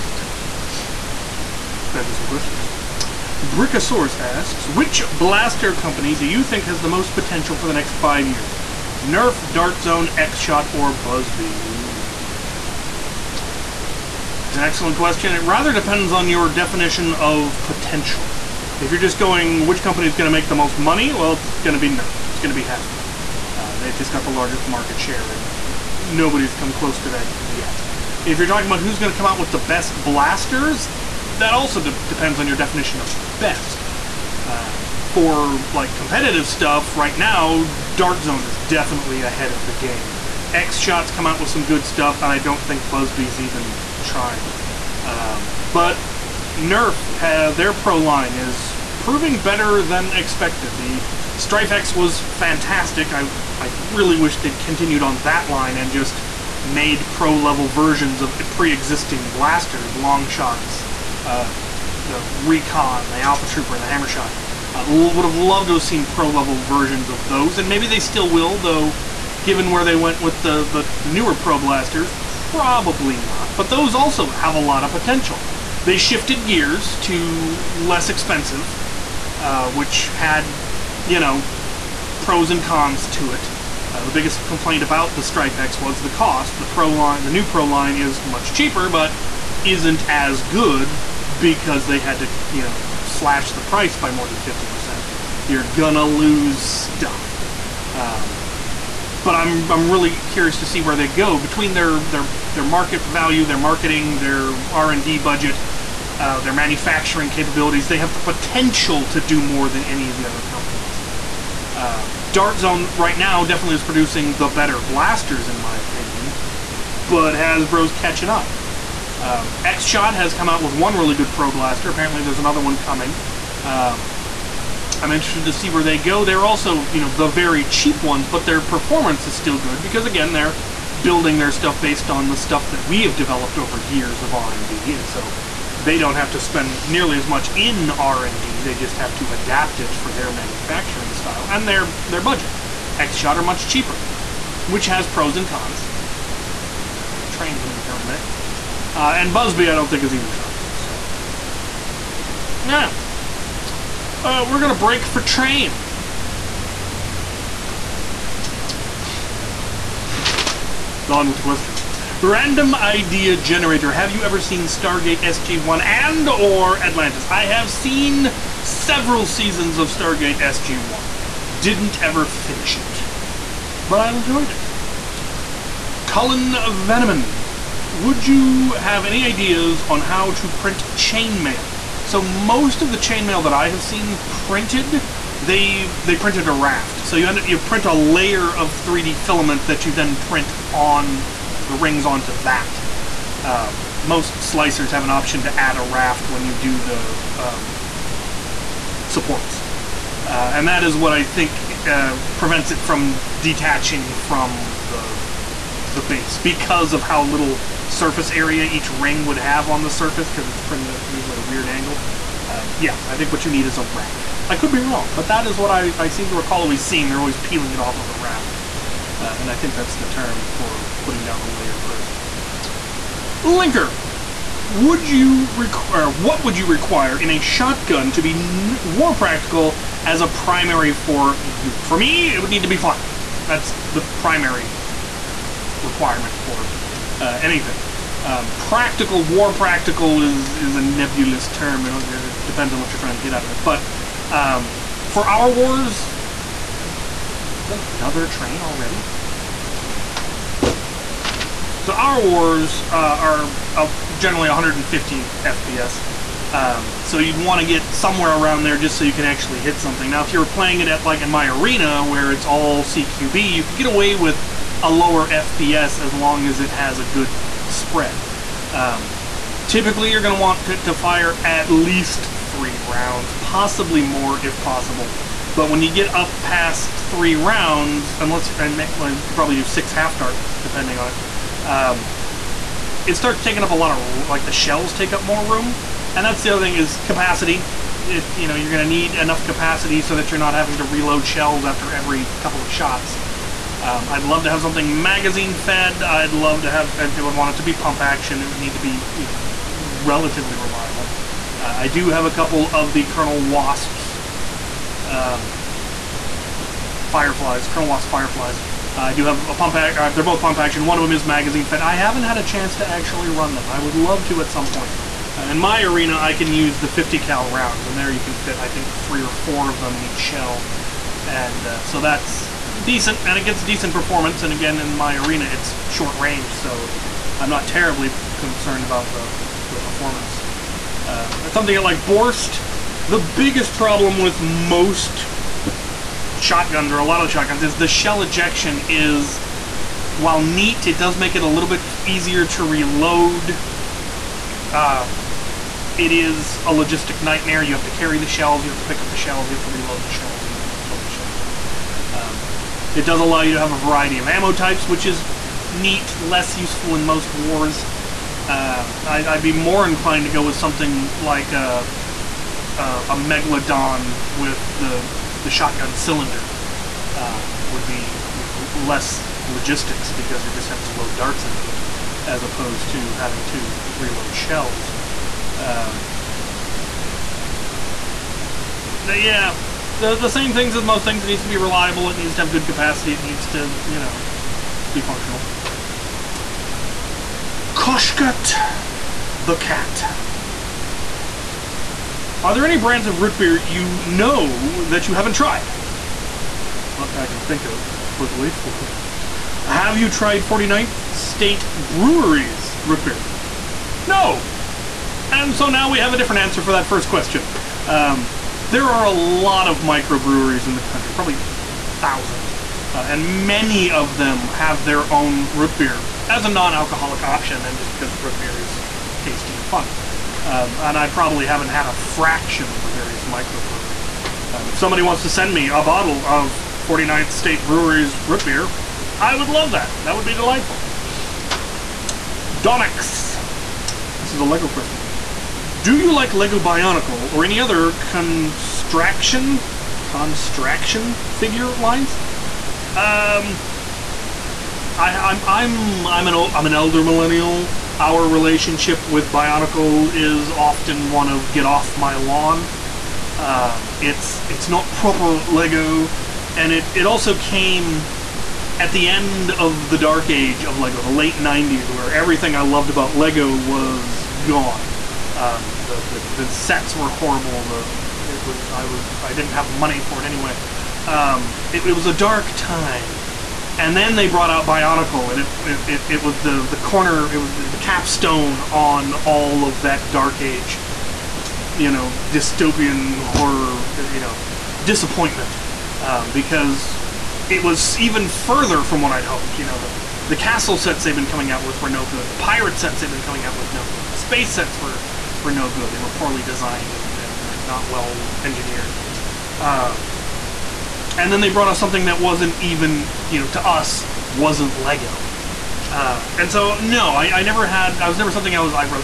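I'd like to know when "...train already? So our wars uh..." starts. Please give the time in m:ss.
4:08.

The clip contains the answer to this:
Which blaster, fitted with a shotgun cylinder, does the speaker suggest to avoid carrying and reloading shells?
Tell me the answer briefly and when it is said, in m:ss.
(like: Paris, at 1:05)
Megalodon, at 6:03.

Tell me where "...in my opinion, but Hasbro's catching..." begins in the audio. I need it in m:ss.
1:55.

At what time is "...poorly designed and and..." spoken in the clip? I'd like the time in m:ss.
8:16.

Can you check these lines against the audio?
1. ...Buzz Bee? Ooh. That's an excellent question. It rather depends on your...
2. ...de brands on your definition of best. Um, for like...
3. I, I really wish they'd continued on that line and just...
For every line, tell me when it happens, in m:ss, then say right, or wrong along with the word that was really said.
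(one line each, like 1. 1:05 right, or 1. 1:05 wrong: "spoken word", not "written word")
1. 0:10 right
2. 0:31 wrong: "depends", not "brands"
3. 0:53 right.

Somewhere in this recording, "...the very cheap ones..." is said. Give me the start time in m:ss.
2:07.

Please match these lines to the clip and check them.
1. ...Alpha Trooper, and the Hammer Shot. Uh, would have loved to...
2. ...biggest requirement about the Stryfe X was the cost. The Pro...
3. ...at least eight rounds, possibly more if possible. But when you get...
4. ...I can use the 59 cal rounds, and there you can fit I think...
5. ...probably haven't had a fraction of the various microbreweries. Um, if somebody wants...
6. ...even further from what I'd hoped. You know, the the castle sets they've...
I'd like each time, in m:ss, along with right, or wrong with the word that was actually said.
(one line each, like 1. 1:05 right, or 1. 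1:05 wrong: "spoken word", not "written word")
1. 1:03 right
2. 1:24 wrong: "complaint", not "requirement"
3. 4:31 wrong: "three", not "eight"
4. 5:16 wrong: "50", not "59"
5. 7:01 right
6. 8:07 right.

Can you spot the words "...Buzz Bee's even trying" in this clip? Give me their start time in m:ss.
0:42.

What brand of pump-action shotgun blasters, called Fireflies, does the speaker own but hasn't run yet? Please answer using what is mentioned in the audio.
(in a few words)
Colonel Wasp.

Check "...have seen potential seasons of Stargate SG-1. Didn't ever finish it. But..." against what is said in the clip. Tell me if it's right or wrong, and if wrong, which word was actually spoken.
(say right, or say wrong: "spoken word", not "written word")
wrong: "several", not "potential".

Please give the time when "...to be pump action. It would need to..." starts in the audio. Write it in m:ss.
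4:57.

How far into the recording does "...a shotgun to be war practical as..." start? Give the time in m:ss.
3:47.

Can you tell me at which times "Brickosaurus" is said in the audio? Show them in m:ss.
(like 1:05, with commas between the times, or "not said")
0:03.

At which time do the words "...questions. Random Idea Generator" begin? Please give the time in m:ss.
2:41.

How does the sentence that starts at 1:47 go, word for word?
They have the potential to do more than any of the other companies.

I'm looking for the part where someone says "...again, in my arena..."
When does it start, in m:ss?
5:24.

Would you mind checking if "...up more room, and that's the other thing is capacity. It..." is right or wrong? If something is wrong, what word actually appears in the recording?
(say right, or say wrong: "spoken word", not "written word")
right.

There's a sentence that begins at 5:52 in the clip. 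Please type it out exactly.
Um, it does allow you to have a variety of ammo types, which is neat, less useful in most wars.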